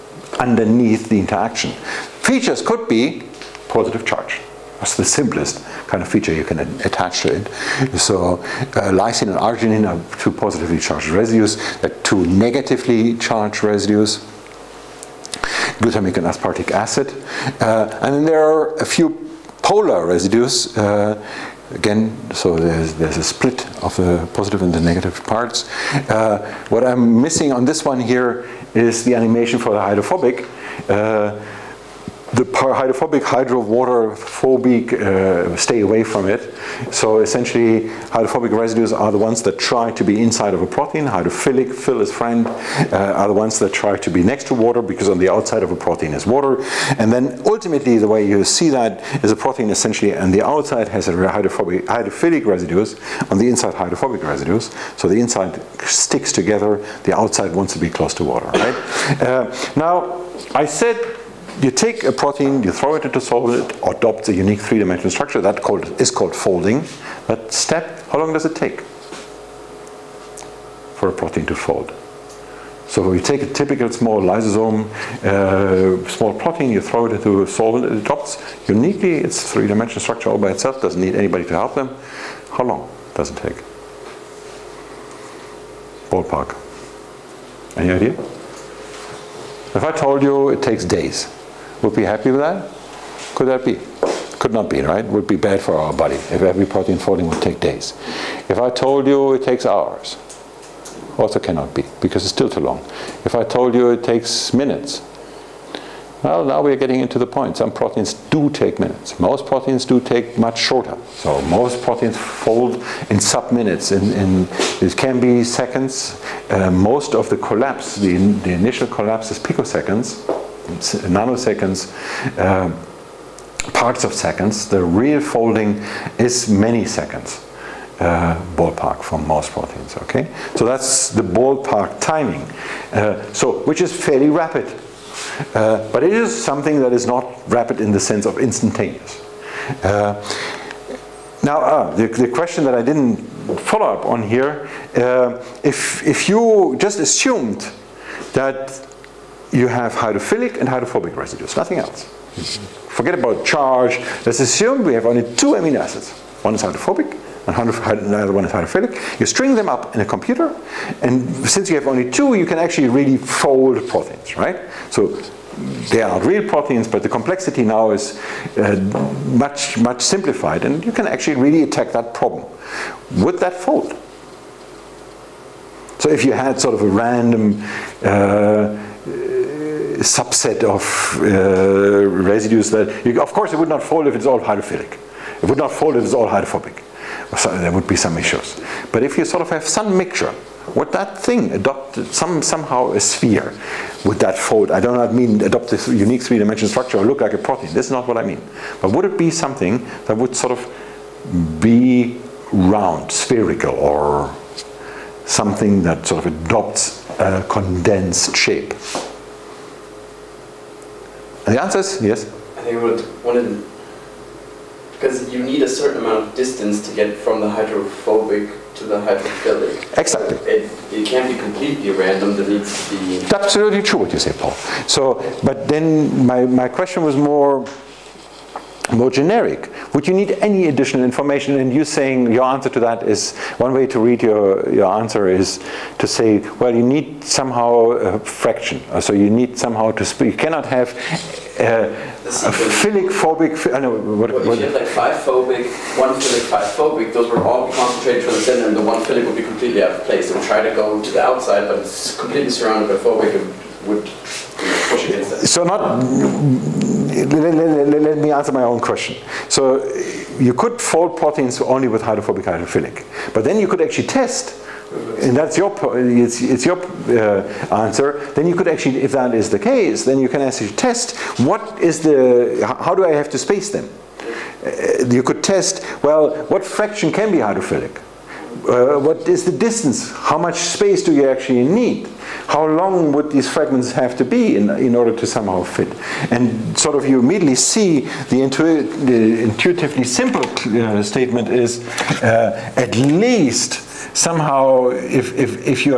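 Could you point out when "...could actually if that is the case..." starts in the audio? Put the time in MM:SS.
04:28.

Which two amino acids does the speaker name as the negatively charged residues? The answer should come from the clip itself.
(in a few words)
glutamic and aspartic acid.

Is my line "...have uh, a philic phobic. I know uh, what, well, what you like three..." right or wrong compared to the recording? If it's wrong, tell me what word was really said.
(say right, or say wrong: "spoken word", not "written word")
wrong: "five", not "three".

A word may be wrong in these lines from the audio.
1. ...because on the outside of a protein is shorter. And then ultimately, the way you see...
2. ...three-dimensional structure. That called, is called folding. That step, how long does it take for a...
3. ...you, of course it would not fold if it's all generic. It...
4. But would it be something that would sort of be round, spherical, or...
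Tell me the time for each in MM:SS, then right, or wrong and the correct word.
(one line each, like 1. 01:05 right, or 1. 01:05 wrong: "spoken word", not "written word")
1. 00:44 wrong: "water", not "shorter"
2. 01:04 right
3. 03:03 wrong: "hydrophilic", not "generic"
4. 03:18 right.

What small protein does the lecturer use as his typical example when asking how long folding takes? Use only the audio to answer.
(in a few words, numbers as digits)
lysozyme.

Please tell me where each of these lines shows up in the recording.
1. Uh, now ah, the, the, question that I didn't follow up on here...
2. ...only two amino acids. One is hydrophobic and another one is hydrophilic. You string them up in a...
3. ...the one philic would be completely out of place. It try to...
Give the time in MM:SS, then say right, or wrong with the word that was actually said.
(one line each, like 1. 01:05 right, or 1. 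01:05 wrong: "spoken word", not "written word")
1. 02:19 right
2. 02:35 right
3. 04:08 right.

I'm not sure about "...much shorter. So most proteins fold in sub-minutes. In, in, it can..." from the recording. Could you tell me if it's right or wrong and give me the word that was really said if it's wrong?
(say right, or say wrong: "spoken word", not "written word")
right.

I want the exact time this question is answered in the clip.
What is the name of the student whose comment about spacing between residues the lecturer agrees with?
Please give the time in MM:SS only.
03:44.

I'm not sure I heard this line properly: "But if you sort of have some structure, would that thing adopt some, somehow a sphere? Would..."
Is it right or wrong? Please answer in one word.
wrong.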